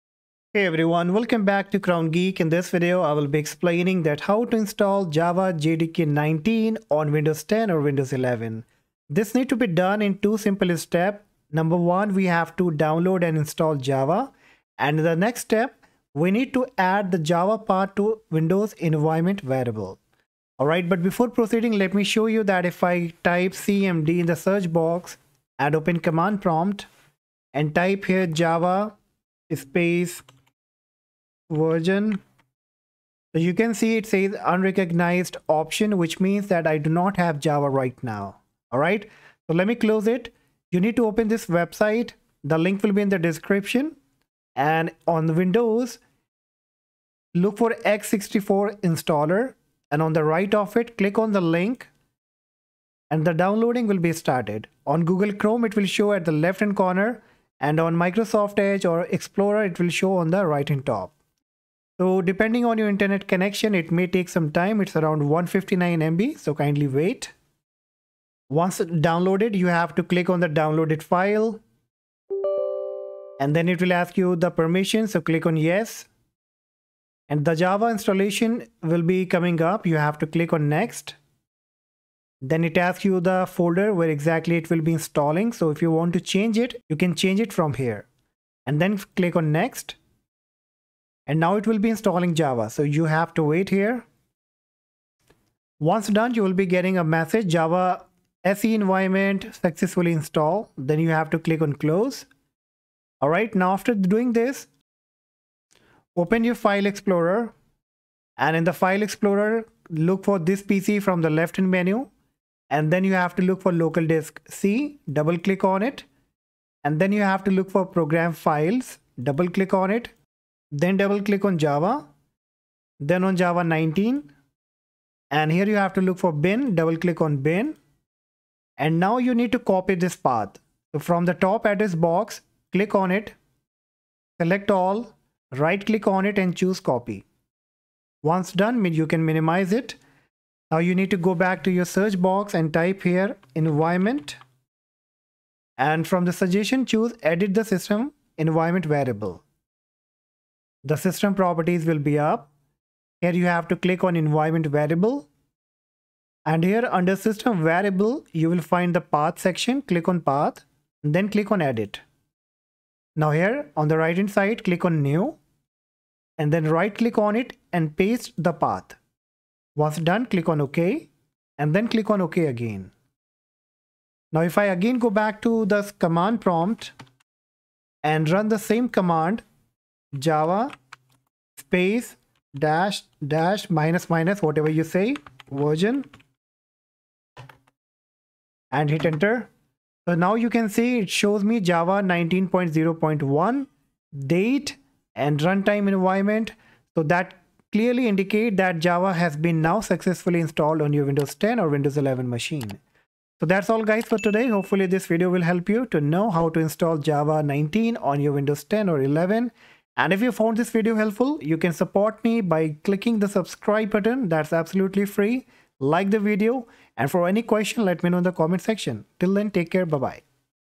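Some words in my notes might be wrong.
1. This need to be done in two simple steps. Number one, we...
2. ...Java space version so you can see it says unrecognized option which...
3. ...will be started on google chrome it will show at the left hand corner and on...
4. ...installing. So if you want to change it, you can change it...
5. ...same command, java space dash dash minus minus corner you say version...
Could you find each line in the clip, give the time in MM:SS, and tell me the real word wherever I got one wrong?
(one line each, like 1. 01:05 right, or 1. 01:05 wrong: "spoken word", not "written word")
1. 00:09 right
2. 00:28 right
3. 00:53 right
4. 01:24 right
5. 02:58 wrong: "whatever", not "corner".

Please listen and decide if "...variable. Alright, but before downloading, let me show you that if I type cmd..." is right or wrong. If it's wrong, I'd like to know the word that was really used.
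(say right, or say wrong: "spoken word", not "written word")
wrong: "proceeding", not "downloading".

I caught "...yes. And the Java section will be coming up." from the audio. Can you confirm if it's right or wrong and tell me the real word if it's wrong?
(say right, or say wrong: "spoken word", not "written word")
wrong: "installation", not "section".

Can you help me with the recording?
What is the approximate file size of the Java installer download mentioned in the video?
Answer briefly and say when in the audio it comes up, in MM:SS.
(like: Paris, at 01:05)
159 MB, at 01:05.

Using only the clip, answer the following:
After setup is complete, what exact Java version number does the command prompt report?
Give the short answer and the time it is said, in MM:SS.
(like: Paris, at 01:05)
19.0.1, at 03:12.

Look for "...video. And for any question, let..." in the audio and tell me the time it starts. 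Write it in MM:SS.
03:36.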